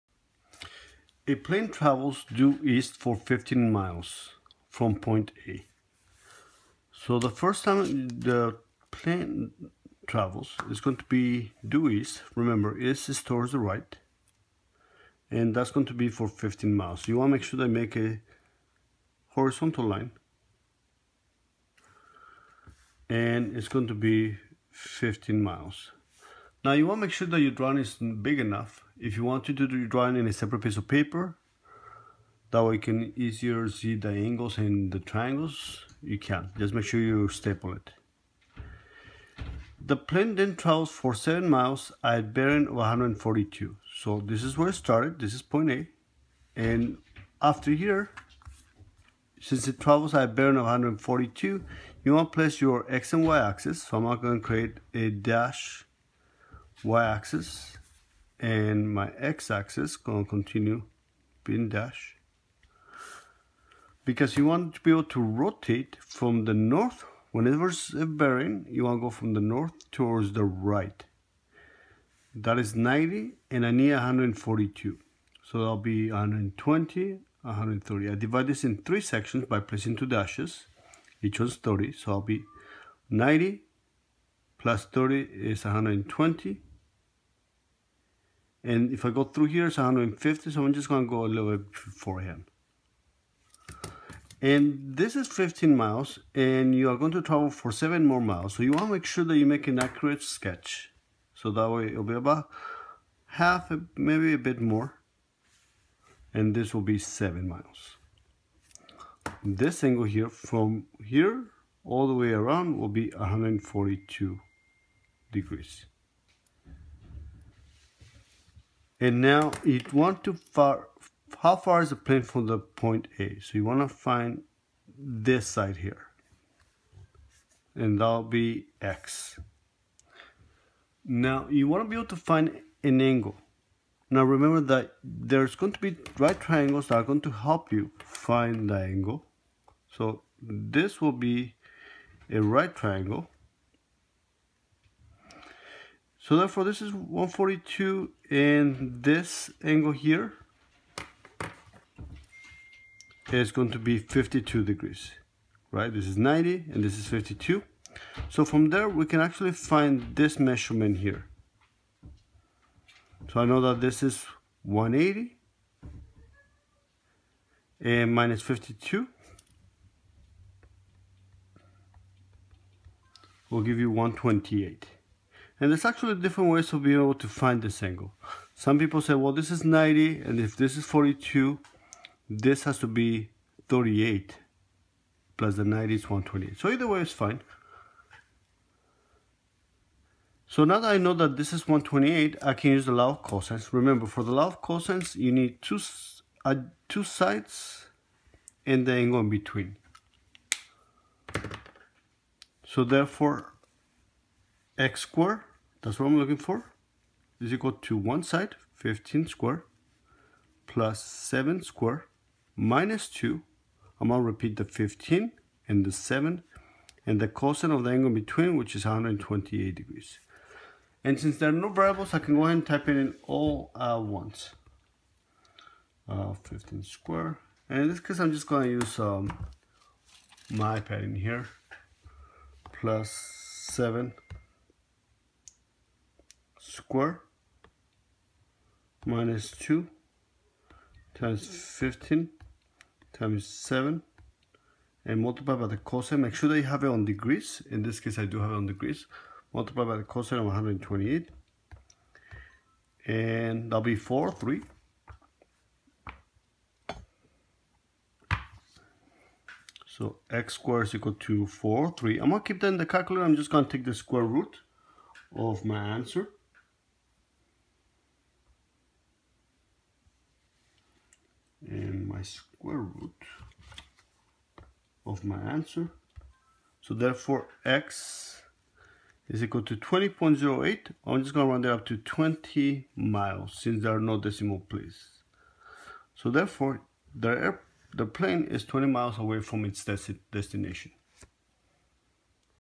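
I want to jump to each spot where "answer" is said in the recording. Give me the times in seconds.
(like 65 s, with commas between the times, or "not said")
265 s, 275 s.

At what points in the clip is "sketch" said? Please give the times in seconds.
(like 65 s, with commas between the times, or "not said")
100 s.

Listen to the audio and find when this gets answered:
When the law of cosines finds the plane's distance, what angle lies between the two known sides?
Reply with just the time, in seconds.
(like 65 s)
218 s.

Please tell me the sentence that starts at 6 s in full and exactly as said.
So the first time the plane travels is going to be due east.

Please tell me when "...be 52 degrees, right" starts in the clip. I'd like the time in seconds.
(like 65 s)
153 s.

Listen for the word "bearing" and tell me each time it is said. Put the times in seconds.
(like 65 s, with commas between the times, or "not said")
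42 s, 50 s, 68 s.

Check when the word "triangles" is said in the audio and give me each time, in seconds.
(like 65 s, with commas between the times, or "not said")
34 s, 136 s, 142 s.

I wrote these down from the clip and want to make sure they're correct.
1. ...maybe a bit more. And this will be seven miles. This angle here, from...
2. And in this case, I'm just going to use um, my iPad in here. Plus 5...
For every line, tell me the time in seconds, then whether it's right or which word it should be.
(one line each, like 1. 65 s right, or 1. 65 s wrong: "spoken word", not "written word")
1. 103 s right
2. 227 s wrong: "7", not "5".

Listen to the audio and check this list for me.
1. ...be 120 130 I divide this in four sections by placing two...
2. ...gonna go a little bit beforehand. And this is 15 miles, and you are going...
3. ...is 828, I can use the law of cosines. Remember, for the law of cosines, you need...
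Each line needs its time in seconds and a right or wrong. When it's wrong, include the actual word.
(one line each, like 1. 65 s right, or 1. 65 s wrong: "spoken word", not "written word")
1. 75 s wrong: "three", not "four"
2. 90 s right
3. 191 s wrong: "128", not "828".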